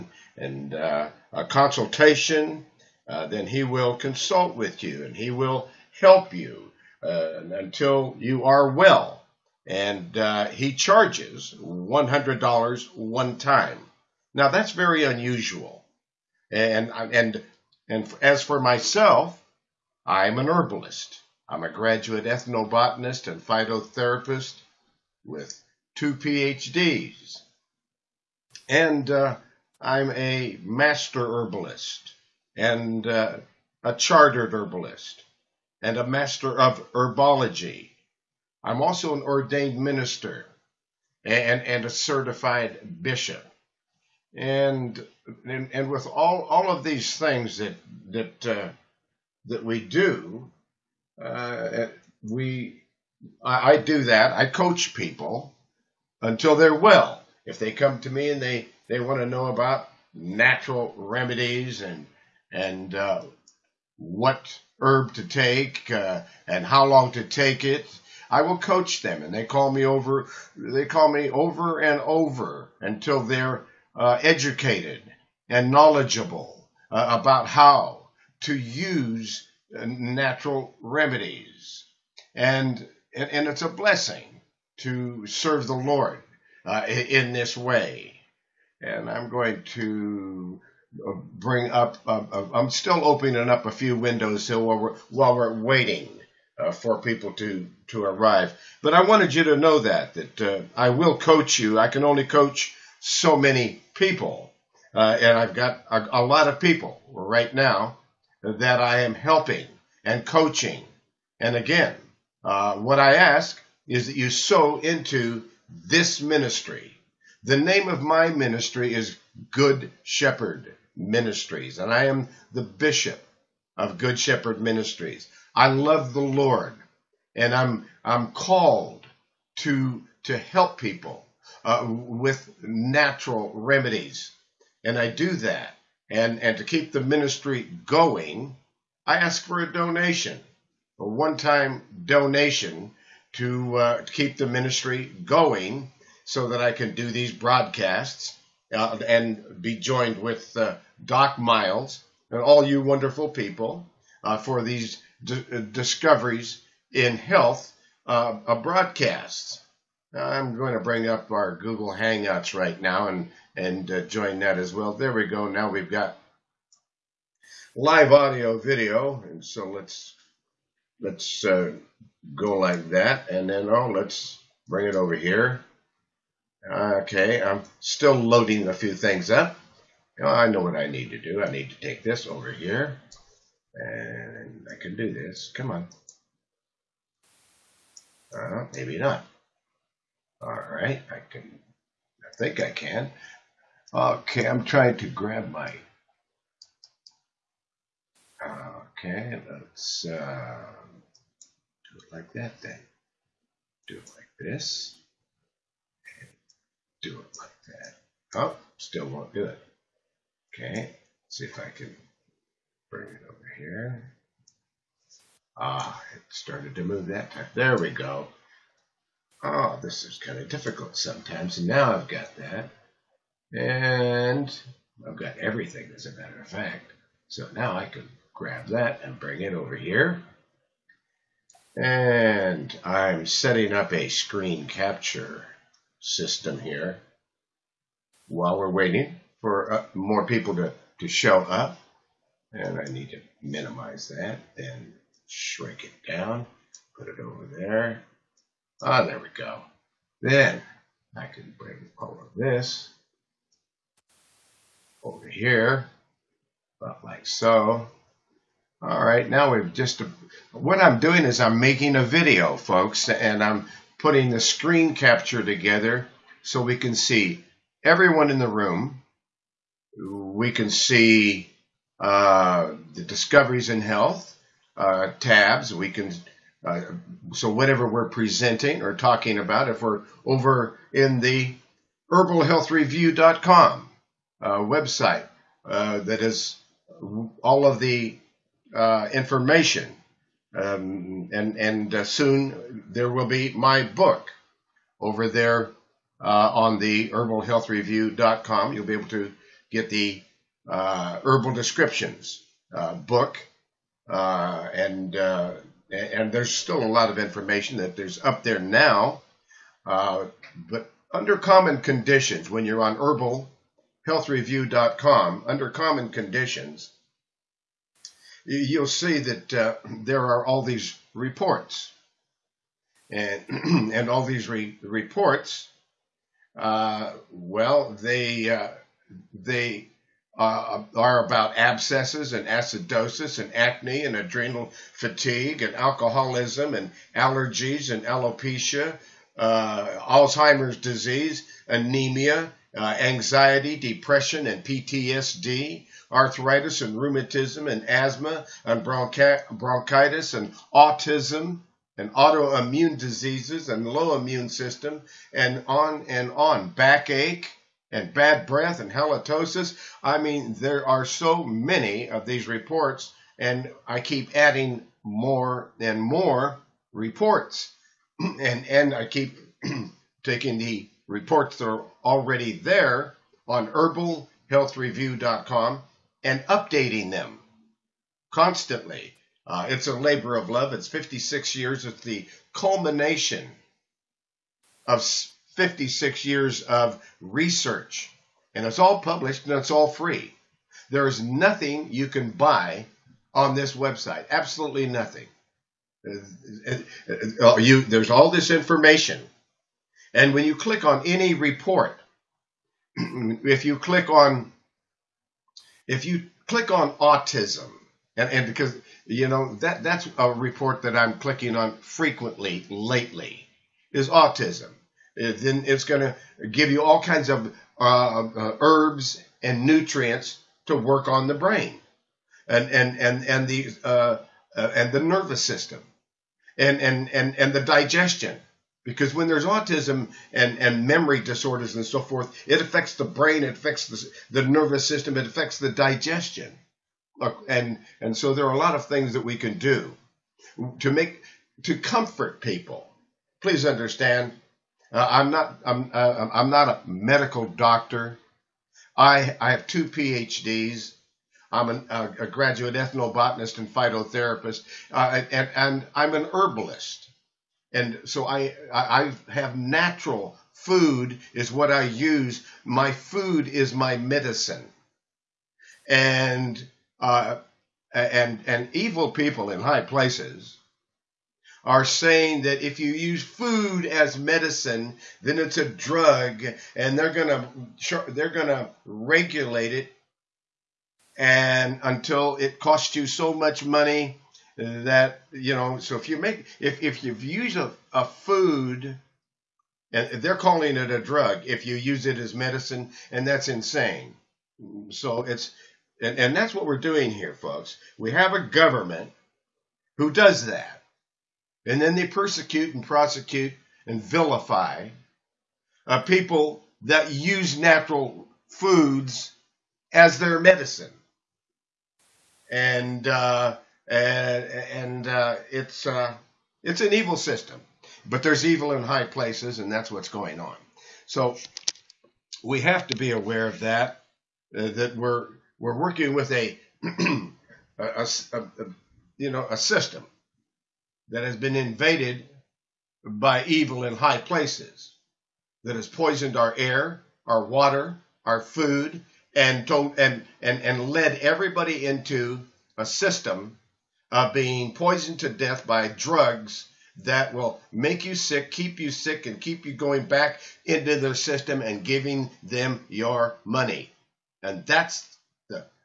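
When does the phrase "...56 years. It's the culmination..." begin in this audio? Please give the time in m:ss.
6:20.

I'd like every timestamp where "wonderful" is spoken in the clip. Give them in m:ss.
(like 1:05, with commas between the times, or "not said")
2:32.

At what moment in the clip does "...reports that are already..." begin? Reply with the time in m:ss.
6:11.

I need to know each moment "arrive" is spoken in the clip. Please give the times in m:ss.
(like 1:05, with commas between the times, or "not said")
1:38.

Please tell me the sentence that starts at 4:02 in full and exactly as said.
And I need to minimize that and shrink it down, put it over there.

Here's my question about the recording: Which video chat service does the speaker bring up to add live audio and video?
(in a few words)
Google Hangouts.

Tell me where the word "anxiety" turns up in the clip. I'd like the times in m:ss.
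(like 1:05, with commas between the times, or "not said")
5:42.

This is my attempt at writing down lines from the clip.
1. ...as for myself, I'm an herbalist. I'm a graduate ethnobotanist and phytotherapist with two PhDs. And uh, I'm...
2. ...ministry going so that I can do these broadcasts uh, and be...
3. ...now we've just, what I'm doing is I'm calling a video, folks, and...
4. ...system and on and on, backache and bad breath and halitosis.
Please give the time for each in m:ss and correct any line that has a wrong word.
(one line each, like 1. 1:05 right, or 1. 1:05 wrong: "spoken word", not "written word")
1. 0:18 right
2. 2:24 right
3. 4:19 wrong: "making", not "calling"
4. 5:54 right.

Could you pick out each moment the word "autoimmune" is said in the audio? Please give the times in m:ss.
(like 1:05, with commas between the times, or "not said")
5:52.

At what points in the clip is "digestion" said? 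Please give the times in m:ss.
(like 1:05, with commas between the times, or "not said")
7:07, 7:15.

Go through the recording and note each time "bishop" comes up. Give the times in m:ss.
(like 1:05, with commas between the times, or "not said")
0:43, 2:02.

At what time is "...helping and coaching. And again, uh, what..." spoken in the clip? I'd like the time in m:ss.
1:49.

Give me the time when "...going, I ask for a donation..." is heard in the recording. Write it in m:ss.
2:17.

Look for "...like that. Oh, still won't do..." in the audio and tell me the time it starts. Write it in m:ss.
3:27.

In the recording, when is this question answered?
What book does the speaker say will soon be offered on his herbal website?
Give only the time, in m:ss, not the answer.
5:00.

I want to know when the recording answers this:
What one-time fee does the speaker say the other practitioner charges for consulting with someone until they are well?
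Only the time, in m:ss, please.
0:11.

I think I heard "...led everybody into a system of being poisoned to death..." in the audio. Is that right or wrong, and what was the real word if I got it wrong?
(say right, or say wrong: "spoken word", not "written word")
right.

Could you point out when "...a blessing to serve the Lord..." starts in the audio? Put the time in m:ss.
1:23.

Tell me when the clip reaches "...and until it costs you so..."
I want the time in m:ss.
8:01.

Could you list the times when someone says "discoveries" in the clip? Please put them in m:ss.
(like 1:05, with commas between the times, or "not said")
2:35, 4:33.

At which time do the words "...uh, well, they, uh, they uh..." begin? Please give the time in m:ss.
5:26.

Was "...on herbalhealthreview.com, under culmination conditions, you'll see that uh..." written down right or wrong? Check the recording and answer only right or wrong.
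wrong.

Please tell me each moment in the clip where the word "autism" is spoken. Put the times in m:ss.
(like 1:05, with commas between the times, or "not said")
5:50, 6:46, 6:54, 7:09.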